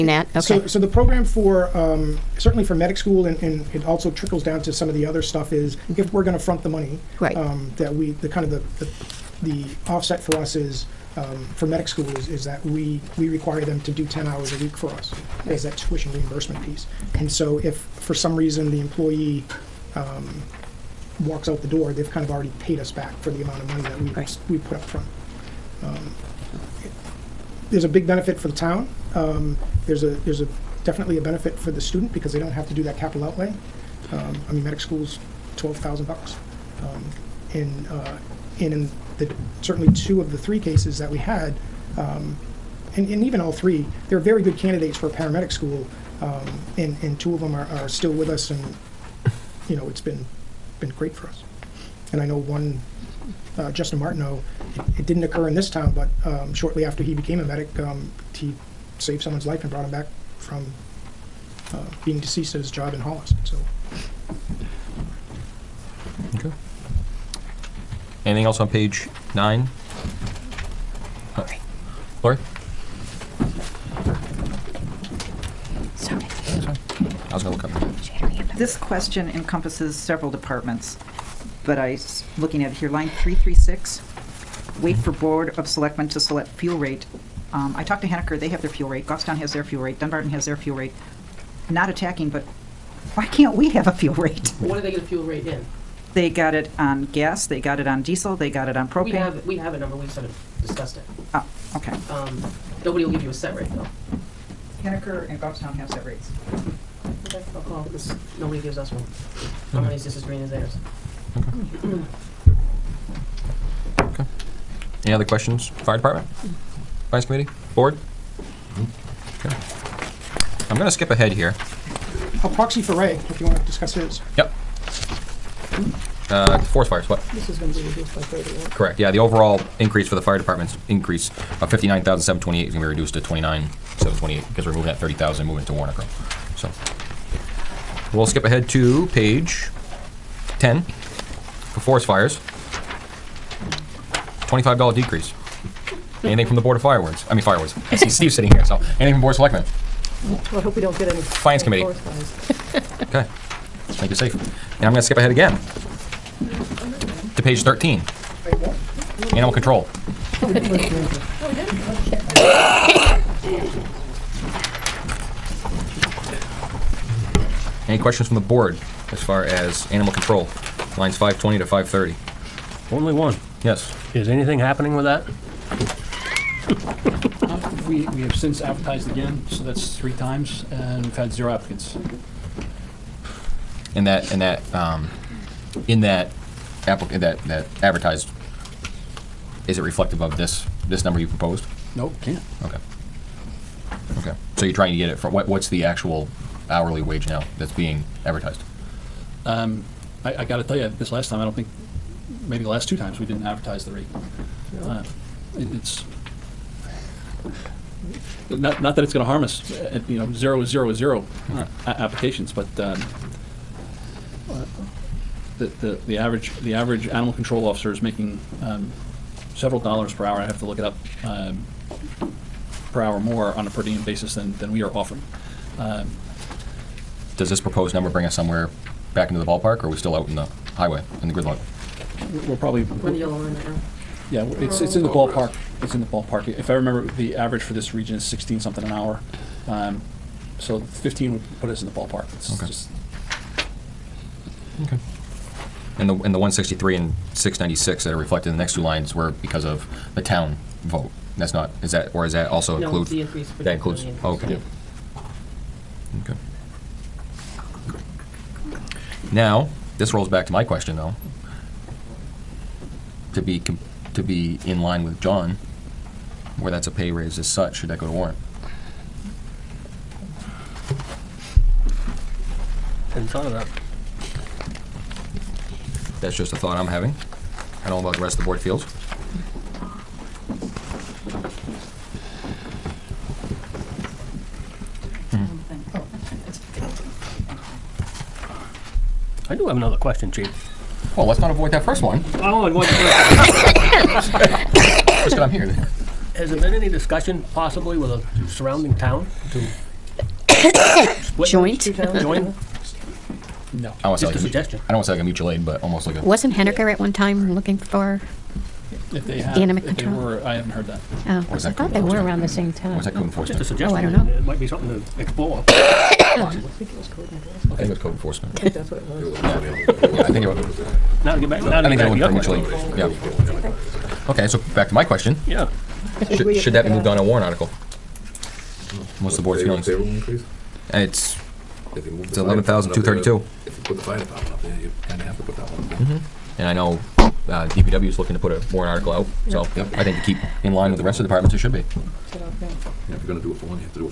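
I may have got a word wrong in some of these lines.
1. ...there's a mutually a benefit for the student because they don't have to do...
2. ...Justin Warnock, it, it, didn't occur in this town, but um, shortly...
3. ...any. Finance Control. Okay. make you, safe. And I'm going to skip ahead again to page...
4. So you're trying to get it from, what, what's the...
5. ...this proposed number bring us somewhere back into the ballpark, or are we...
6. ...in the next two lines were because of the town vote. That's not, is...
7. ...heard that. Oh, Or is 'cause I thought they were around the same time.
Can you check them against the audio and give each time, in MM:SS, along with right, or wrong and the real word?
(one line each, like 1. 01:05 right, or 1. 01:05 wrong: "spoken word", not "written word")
1. 00:30 wrong: "definitely", not "mutually"
2. 00:53 wrong: "Martineau", not "Warnock"
3. 02:31 wrong: "Committee", not "Control"
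4. 03:14 right
5. 03:47 right
6. 04:08 right
7. 05:10 right.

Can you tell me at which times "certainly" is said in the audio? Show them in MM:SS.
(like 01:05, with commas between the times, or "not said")
00:02, 00:39.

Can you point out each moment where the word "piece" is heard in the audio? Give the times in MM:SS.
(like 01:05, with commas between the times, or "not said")
00:16.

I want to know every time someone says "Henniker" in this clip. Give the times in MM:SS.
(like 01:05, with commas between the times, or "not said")
01:28, 01:44, 05:06.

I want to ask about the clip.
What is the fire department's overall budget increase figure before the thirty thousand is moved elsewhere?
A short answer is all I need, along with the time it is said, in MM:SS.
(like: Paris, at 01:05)
$59,728, at 02:11.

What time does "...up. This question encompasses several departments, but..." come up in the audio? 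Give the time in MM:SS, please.
01:17.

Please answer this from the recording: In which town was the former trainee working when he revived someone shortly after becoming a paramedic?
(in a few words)
Hollis.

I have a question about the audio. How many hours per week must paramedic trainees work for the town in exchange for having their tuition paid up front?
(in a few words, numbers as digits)
10.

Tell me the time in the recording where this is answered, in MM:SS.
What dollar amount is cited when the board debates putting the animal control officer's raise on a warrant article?
05:32.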